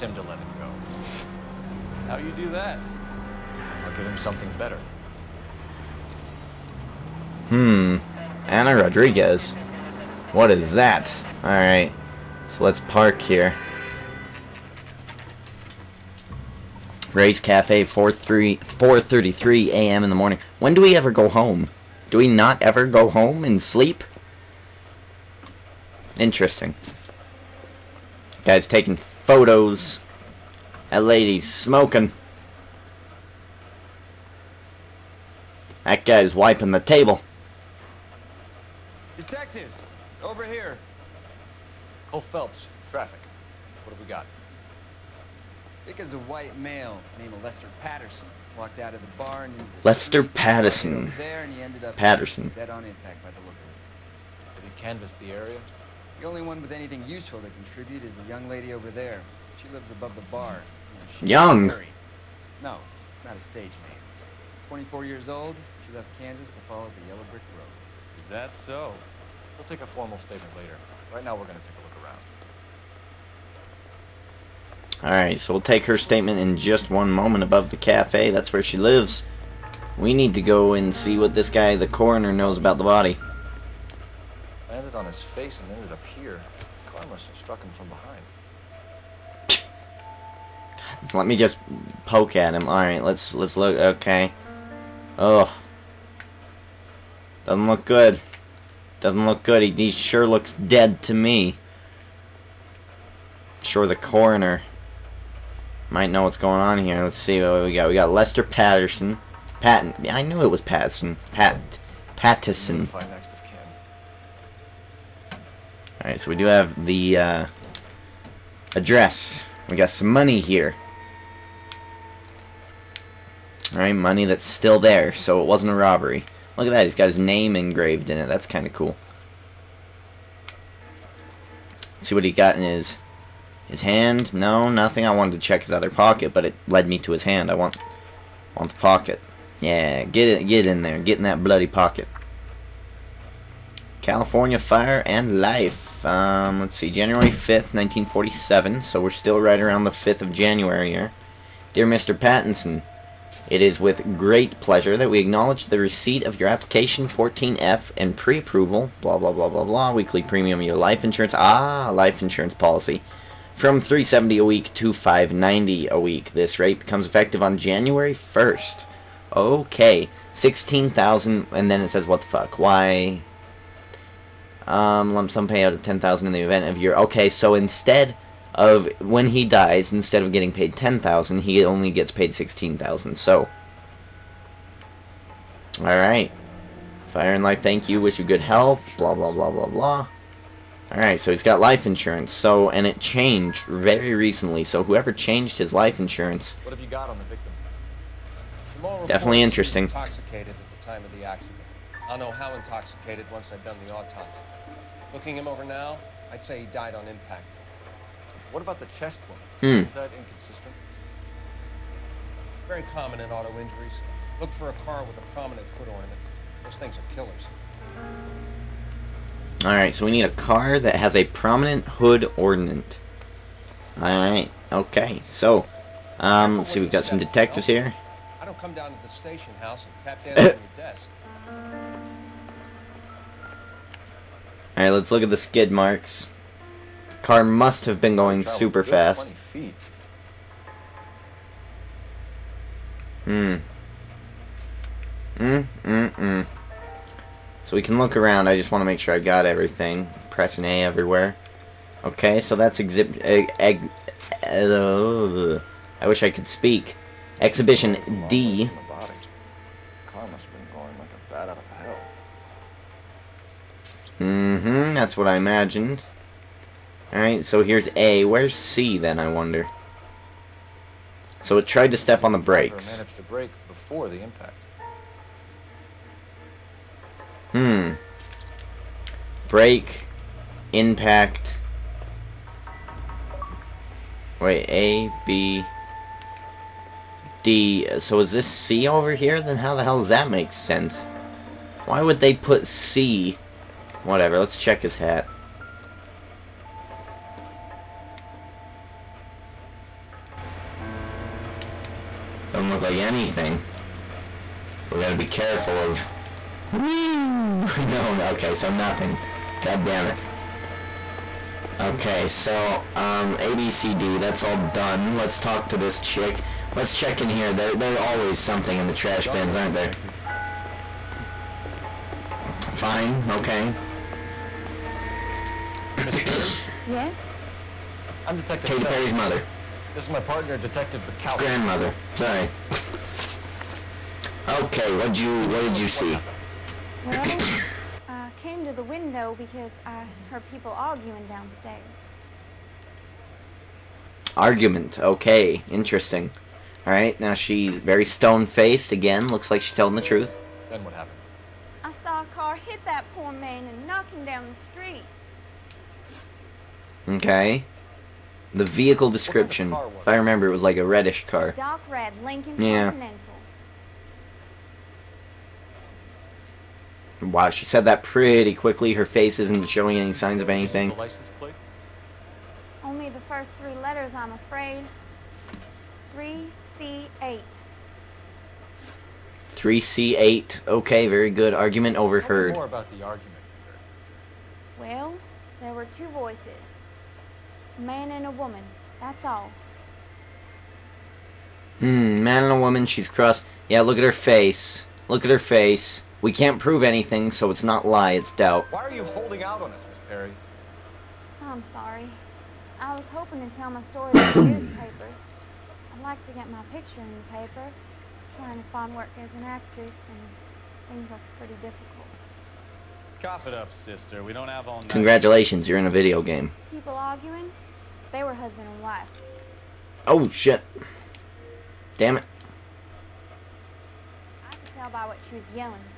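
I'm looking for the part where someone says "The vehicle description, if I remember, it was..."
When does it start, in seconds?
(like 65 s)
358 s.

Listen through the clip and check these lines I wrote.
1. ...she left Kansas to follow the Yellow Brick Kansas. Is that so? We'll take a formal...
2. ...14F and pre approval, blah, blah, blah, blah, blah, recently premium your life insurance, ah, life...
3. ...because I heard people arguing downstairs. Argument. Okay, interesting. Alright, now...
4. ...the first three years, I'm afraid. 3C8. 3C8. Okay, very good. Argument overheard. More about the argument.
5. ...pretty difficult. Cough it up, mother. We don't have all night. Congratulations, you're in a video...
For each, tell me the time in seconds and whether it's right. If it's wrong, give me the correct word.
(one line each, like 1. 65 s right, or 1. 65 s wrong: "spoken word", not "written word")
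1. 65 s wrong: "Road", not "Kansas"
2. 157 s wrong: "weekly", not "recently"
3. 339 s right
4. 373 s wrong: "letters", not "years"
5. 411 s wrong: "sister", not "mother".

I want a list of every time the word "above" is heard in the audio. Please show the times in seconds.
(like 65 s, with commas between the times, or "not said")
59 s, 77 s.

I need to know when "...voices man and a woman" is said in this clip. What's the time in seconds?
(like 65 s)
386 s.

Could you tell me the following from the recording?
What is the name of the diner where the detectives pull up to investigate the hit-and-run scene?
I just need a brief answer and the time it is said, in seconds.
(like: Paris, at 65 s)
Ray's Cafe, at 17 s.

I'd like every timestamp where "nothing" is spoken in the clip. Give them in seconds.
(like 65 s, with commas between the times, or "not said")
134 s, 308 s.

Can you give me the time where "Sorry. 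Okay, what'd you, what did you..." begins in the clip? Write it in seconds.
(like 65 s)
332 s.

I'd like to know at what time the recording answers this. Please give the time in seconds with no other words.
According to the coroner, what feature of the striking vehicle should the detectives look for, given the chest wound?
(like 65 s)
221 s.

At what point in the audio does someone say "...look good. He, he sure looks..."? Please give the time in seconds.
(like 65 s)
99 s.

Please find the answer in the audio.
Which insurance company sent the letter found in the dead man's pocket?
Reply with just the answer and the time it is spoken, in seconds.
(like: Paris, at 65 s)
California Fire and Life, at 144 s.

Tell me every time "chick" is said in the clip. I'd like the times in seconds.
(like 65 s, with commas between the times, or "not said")
315 s.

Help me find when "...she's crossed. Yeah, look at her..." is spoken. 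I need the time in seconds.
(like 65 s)
392 s.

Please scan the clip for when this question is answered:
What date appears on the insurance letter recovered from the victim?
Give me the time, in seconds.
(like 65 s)
146 s.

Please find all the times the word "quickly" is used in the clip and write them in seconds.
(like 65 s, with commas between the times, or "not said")
368 s.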